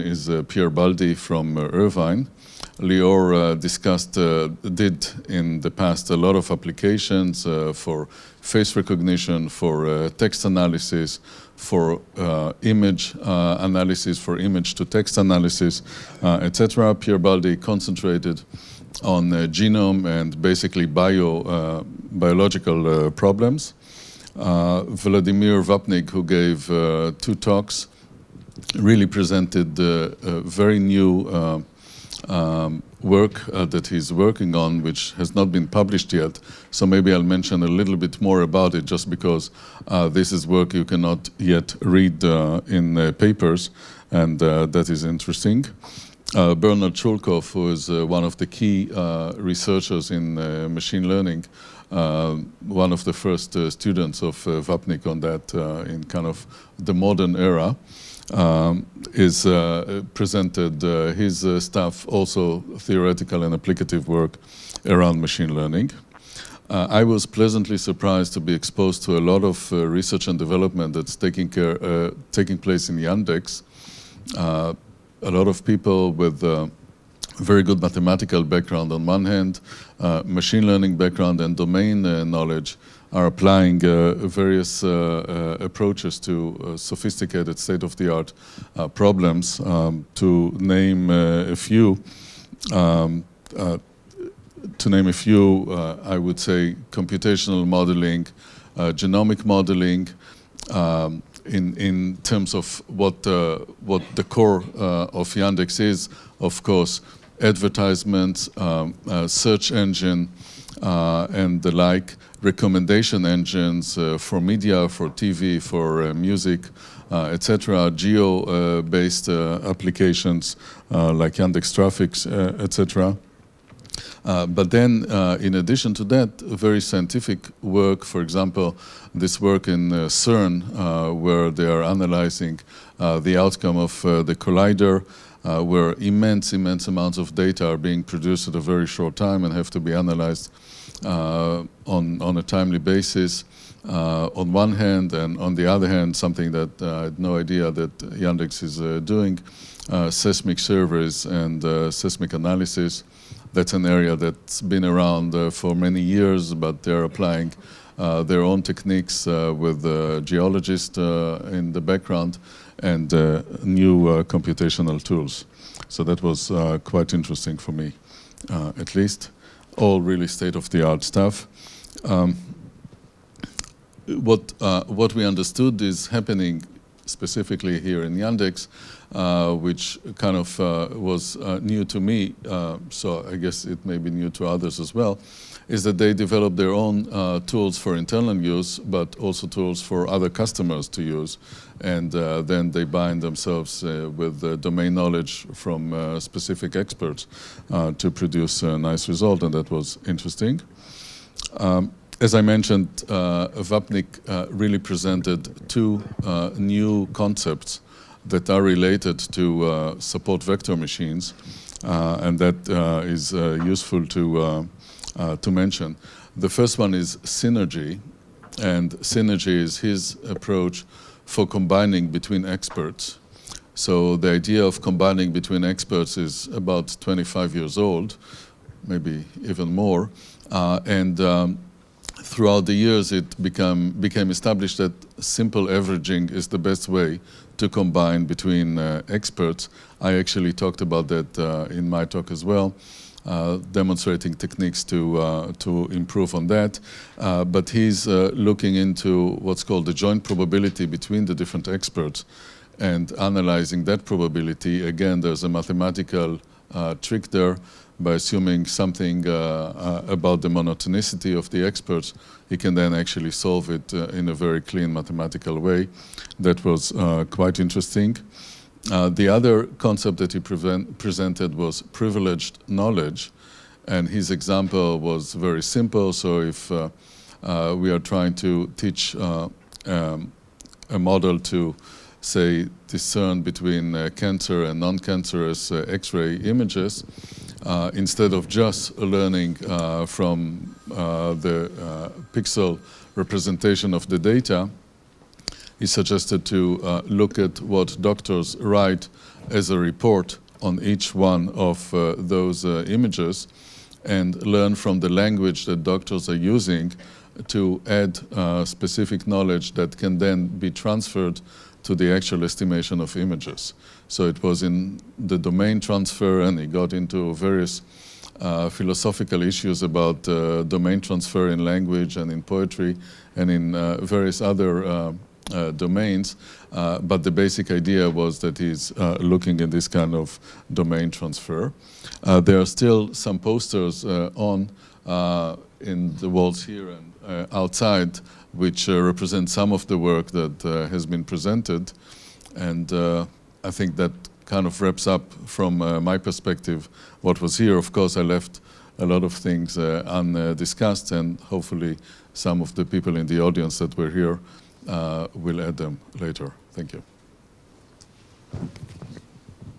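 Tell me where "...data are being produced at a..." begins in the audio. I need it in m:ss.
2:17.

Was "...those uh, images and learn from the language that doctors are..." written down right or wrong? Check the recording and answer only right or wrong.
right.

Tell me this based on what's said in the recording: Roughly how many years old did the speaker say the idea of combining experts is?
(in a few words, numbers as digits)
25.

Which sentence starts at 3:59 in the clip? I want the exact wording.
I actually talked about that uh, in my talk as well.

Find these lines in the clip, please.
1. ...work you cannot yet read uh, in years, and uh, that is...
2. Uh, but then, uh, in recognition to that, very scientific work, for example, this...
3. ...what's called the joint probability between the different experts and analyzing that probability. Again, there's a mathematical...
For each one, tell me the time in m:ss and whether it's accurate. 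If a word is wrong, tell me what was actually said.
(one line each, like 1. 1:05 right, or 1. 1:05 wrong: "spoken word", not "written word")
1. 0:40 wrong: "papers", not "years"
2. 2:04 wrong: "addition", not "recognition"
3. 4:09 right.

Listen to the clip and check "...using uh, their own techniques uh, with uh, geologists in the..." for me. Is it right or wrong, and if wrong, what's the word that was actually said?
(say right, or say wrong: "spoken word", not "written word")
wrong: "applying", not "using".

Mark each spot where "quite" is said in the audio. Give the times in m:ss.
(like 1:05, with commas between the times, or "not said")
2:46, 4:27.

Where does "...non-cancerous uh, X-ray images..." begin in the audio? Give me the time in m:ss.
4:44.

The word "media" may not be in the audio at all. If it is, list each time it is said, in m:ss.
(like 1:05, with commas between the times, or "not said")
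1:54.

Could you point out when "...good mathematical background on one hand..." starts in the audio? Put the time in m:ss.
1:17.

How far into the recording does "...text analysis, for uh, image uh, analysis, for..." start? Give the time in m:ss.
0:10.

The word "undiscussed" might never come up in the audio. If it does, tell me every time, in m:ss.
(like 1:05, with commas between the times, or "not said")
5:49.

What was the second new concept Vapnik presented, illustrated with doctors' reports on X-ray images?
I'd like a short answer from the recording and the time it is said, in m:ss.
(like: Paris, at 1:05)
privileged knowledge, at 4:31.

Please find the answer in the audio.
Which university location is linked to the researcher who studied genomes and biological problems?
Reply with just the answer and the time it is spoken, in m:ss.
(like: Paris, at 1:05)
Irvine, at 0:01.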